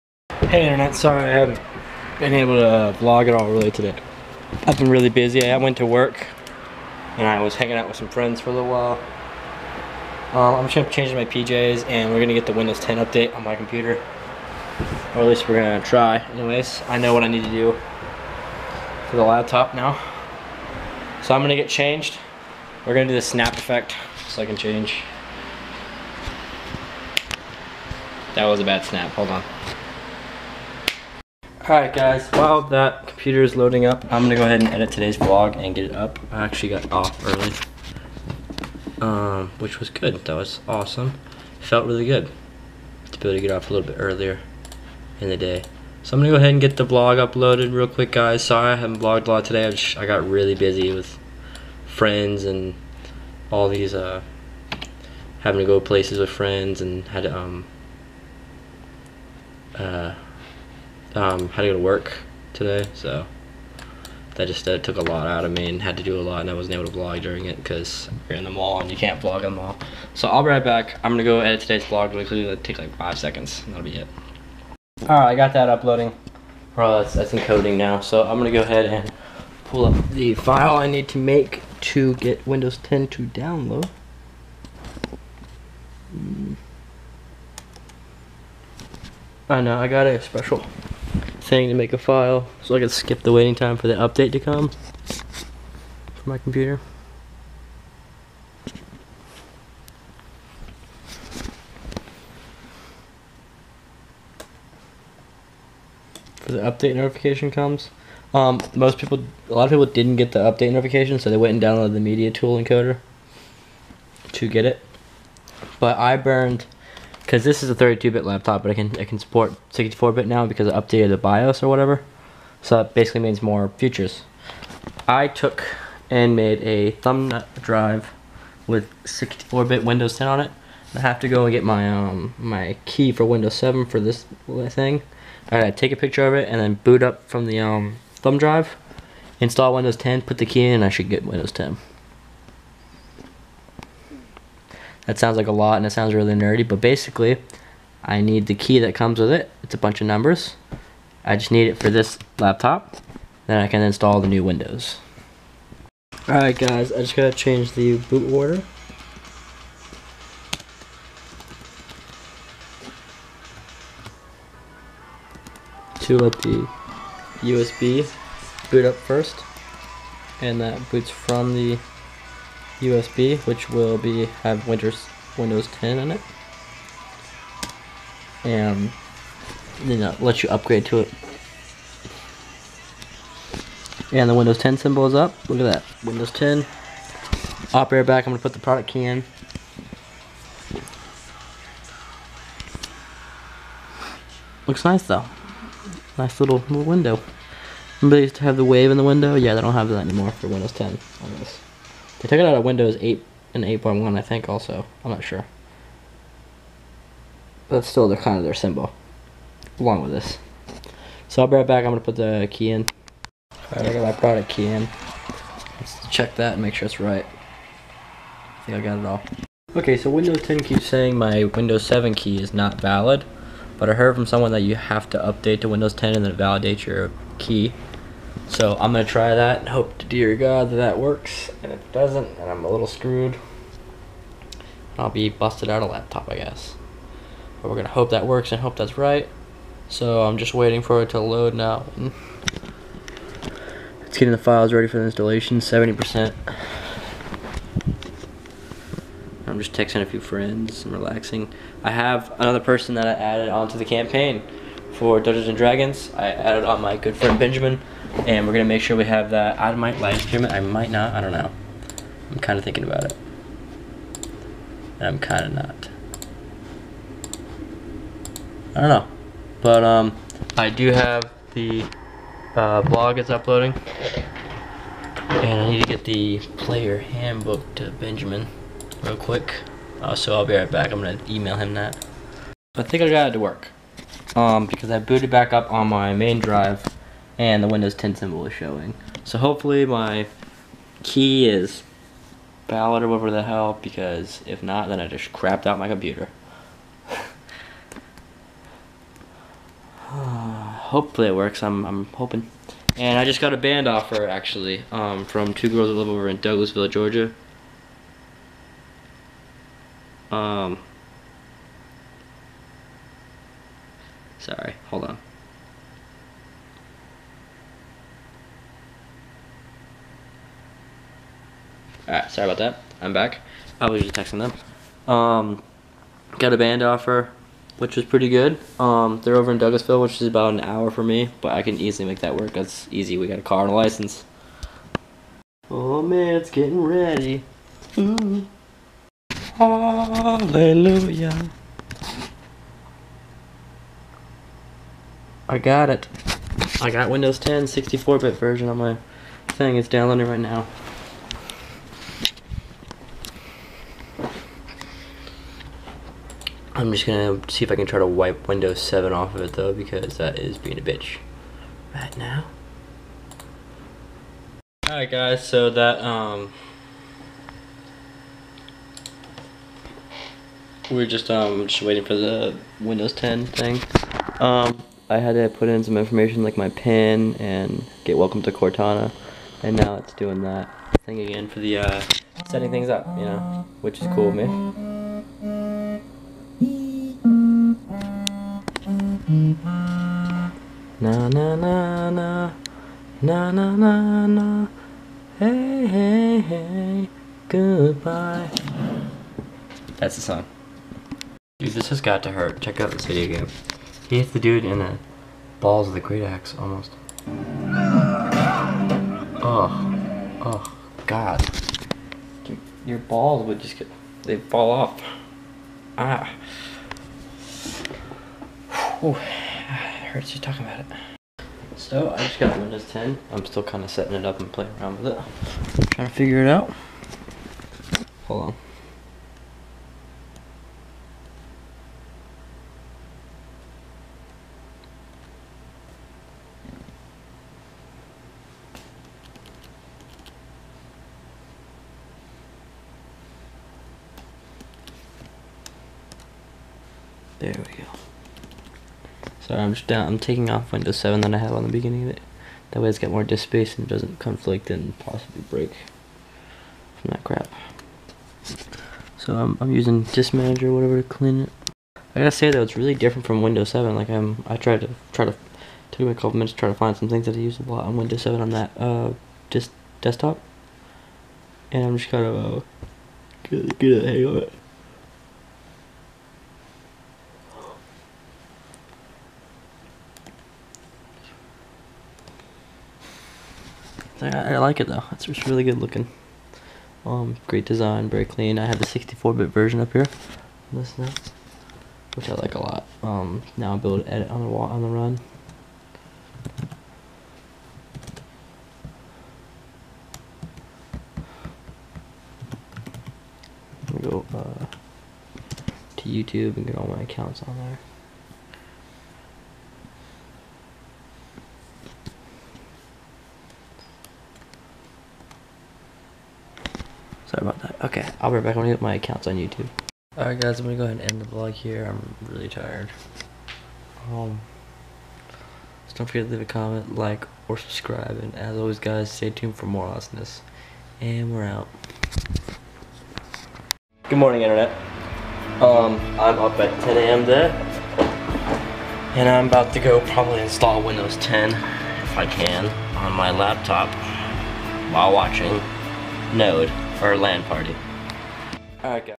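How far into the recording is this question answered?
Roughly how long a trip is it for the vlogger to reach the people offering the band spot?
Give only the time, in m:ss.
5:30.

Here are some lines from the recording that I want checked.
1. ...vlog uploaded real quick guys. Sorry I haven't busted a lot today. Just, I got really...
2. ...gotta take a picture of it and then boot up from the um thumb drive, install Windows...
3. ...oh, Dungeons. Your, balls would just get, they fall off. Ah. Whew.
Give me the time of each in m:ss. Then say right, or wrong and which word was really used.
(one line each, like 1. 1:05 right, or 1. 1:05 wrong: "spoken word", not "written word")
1. 0:46 wrong: "vlogged", not "busted"
2. 2:15 right
3. 6:50 wrong: "God", not "Dungeons".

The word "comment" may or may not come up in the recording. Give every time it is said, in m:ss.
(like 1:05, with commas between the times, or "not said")
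8:46.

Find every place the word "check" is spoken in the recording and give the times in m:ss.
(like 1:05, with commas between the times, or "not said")
3:36, 6:42.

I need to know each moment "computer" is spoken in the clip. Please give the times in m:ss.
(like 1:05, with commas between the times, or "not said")
0:13, 0:33, 1:36, 4:55.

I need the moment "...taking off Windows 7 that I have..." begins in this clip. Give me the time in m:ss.
7:30.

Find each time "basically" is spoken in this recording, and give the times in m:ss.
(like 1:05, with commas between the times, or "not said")
2:02, 2:26.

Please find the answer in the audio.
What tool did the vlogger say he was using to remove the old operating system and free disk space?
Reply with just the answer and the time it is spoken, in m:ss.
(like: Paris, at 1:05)
Disk Manager, at 7:40.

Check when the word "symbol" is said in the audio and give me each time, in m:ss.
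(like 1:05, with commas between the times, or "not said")
3:04, 3:28, 4:48.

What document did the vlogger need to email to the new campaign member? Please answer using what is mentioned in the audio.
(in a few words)
player handbook.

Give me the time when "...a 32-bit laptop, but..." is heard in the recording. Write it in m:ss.
1:57.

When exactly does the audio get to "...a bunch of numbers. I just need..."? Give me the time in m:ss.
2:29.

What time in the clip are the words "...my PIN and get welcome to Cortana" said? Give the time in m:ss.
6:16.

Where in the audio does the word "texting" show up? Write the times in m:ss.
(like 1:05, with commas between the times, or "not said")
4:09, 5:24.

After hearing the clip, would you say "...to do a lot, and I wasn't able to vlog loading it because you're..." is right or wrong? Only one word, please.
wrong.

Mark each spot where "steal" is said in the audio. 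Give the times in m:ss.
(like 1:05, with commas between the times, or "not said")
not said.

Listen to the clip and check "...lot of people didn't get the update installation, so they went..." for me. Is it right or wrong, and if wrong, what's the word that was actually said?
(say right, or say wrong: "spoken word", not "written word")
wrong: "notification", not "installation".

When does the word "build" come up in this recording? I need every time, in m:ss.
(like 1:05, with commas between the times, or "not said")
8:13.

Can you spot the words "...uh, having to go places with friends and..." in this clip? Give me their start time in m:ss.
0:53.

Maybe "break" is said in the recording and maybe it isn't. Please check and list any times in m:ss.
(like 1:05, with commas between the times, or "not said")
7:35.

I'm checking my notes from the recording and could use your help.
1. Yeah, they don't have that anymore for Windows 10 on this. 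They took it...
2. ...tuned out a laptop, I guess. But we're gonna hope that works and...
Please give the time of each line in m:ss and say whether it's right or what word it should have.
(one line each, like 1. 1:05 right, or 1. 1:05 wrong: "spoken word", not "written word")
1. 3:19 right
2. 3:55 wrong: "busted", not "tuned".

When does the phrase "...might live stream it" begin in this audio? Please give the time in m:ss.
4:19.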